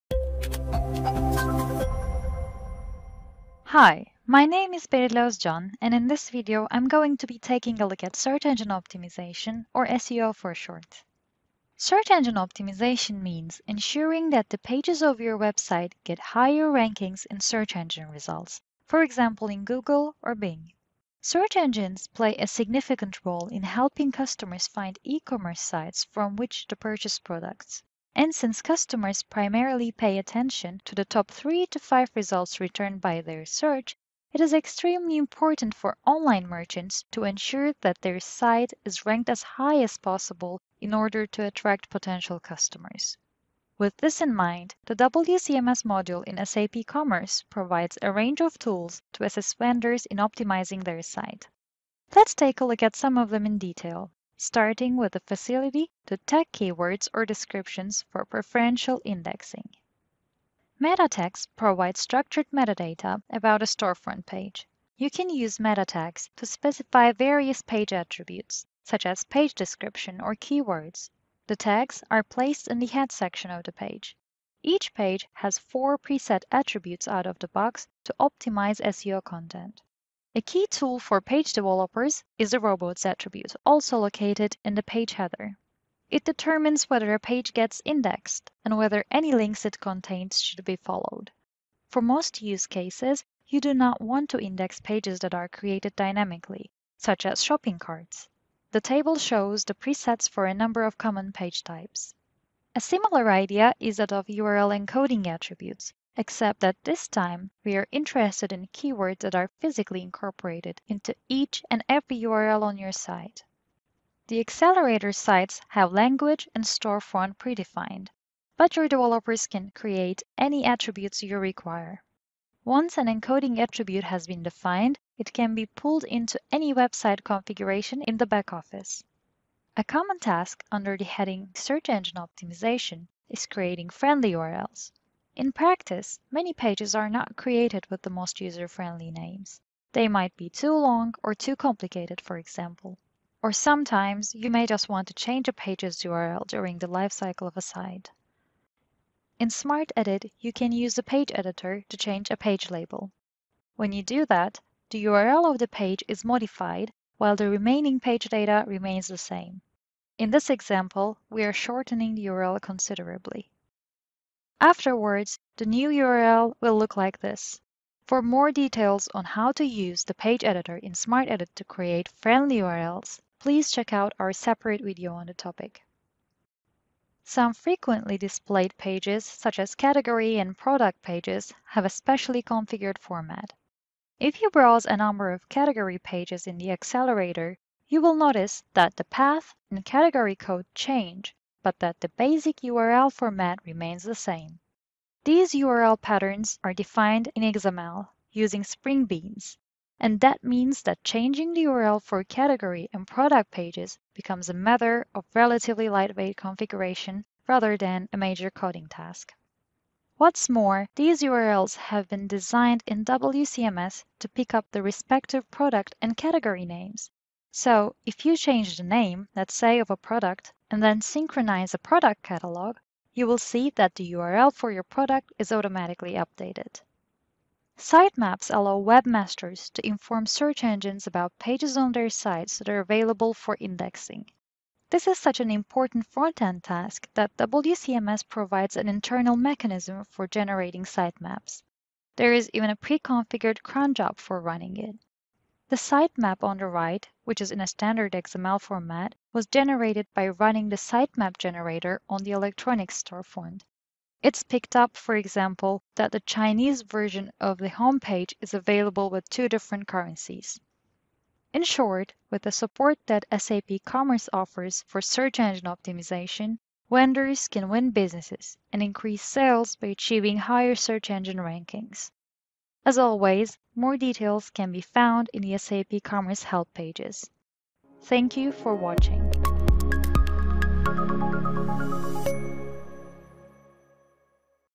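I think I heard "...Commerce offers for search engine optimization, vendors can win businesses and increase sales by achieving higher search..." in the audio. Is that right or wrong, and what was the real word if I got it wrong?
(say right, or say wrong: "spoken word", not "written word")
right.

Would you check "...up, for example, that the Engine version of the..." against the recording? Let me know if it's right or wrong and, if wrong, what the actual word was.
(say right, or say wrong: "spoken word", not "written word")
wrong: "Chinese", not "Engine".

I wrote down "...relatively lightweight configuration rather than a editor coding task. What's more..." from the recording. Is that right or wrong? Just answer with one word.
wrong.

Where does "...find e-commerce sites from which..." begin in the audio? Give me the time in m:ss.
0:24.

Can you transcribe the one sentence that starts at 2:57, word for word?
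Some frequently displayed pages, such as category and product pages, have a specially configured format.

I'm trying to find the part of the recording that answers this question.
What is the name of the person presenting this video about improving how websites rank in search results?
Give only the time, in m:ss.
0:04.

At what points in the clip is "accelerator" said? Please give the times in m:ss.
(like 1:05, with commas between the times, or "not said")
1:54, 3:06.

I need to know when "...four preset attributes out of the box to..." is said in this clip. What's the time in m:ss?
1:15.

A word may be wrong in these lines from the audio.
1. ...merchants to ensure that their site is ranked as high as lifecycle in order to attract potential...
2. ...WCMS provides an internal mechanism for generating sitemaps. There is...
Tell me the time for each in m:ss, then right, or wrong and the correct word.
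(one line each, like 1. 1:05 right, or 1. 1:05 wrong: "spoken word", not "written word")
1. 0:36 wrong: "possible", not "lifecycle"
2. 3:57 right.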